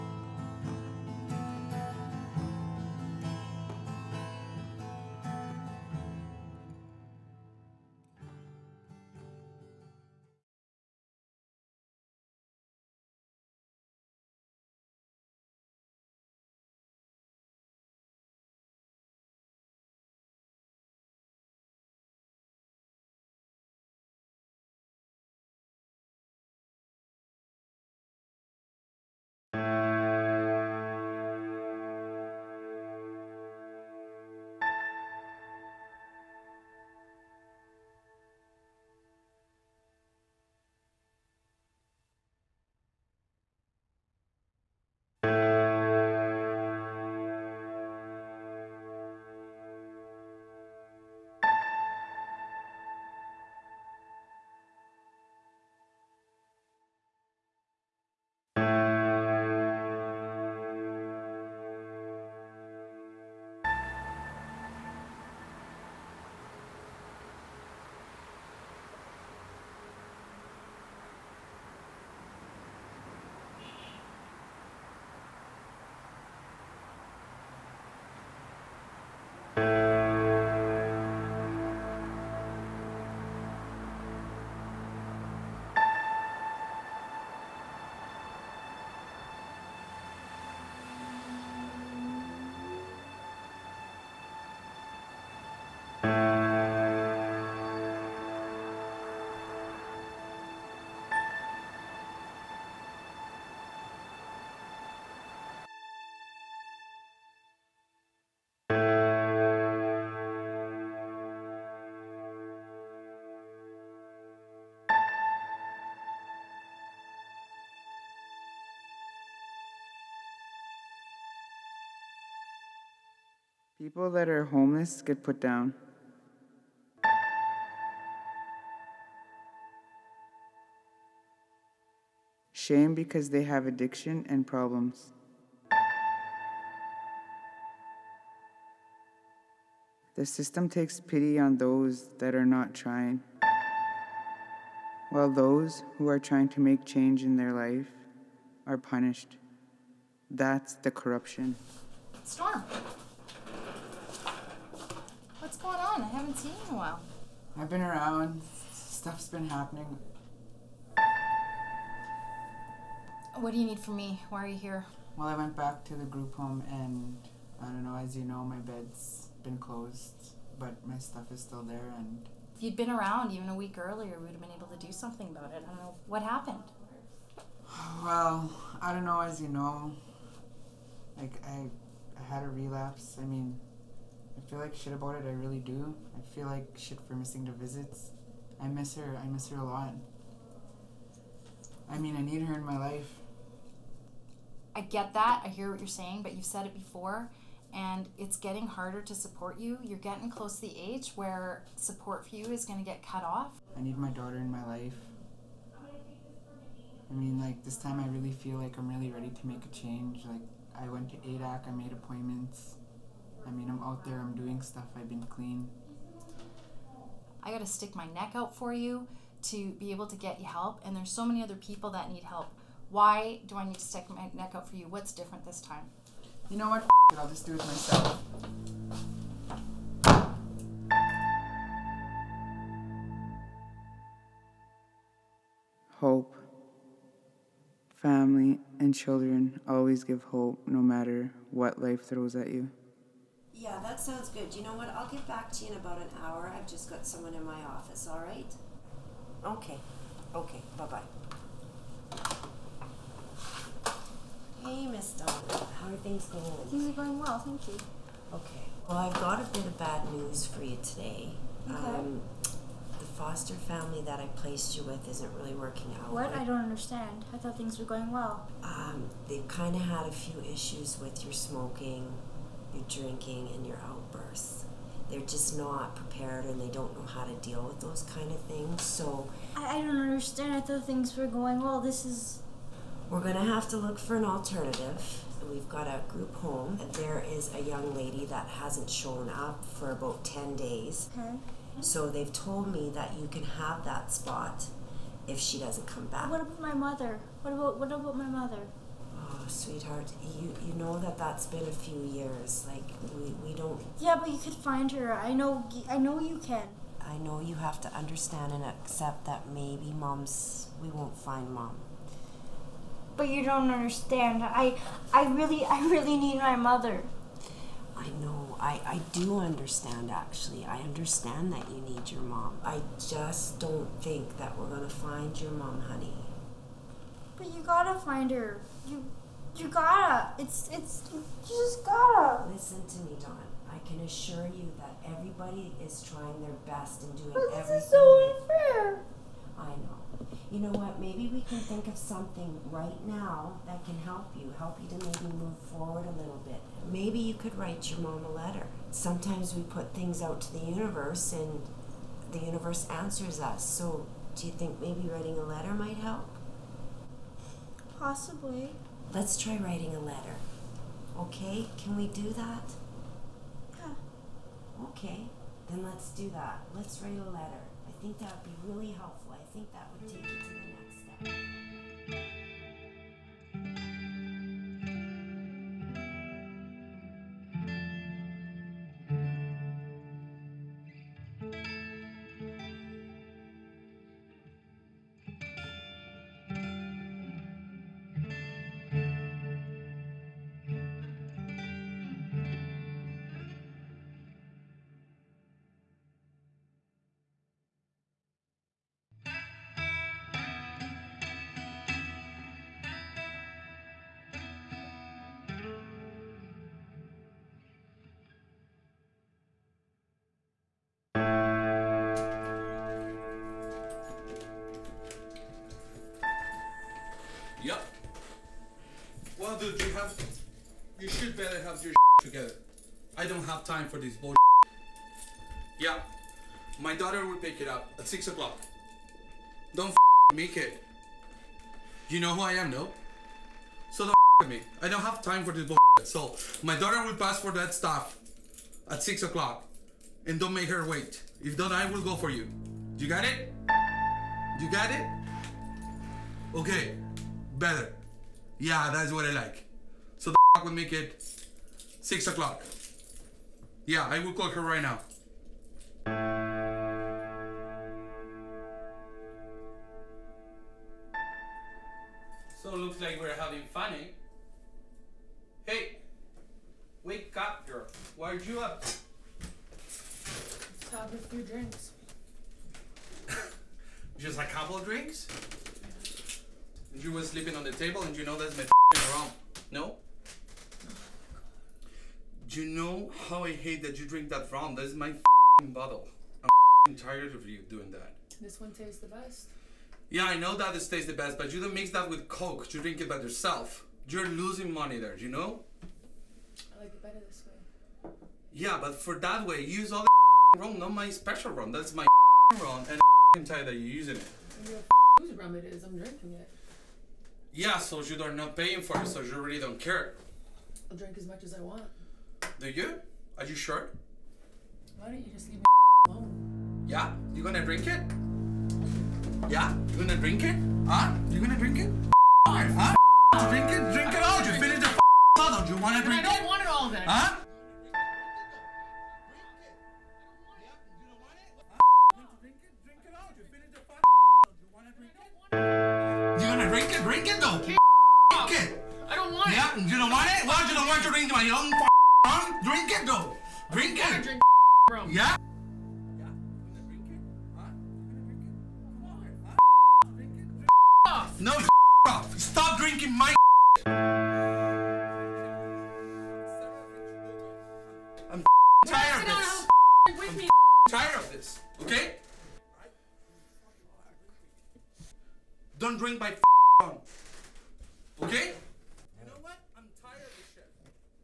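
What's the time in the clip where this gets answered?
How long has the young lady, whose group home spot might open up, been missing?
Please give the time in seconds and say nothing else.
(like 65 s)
290 s.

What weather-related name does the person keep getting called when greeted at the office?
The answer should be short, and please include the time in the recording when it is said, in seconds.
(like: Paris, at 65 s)
Storm, at 152 s.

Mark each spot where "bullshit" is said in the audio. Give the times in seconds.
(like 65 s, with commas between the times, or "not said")
424 s, 435 s.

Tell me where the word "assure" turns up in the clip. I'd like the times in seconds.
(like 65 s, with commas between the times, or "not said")
334 s.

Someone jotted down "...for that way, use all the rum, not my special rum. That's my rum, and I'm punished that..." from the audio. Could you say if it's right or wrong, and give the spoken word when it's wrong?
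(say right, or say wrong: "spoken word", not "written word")
wrong: "tired", not "punished".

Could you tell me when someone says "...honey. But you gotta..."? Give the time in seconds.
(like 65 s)
325 s.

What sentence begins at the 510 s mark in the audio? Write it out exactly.
I'll drink as much as I want.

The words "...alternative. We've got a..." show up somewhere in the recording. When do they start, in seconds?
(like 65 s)
284 s.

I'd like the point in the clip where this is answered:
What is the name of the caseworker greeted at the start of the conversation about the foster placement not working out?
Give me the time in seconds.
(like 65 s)
254 s.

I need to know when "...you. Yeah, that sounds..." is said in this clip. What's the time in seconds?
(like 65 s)
242 s.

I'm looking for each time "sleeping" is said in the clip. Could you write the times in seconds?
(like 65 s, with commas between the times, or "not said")
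477 s.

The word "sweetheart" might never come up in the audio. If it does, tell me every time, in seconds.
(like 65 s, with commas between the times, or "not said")
299 s.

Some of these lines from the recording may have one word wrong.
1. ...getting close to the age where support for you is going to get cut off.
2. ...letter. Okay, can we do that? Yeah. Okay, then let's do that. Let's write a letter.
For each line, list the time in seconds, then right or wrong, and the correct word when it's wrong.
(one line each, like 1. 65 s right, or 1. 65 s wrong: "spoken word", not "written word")
1. 199 s right
2. 359 s right.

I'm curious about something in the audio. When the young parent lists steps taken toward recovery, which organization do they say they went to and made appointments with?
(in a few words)
AADAC.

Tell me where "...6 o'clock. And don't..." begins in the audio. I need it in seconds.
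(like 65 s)
439 s.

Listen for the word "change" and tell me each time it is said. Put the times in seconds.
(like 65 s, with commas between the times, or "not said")
146 s, 209 s.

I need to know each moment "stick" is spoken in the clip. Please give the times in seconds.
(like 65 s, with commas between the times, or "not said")
217 s, 223 s.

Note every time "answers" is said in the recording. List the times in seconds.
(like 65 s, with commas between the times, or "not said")
352 s.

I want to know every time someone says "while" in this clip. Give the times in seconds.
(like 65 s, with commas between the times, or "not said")
145 s, 156 s.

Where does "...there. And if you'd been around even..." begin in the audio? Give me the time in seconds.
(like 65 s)
171 s.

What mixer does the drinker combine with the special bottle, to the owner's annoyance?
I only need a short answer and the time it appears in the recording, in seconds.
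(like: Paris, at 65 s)
Coke, at 492 s.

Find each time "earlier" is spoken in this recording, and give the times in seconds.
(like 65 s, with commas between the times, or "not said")
173 s.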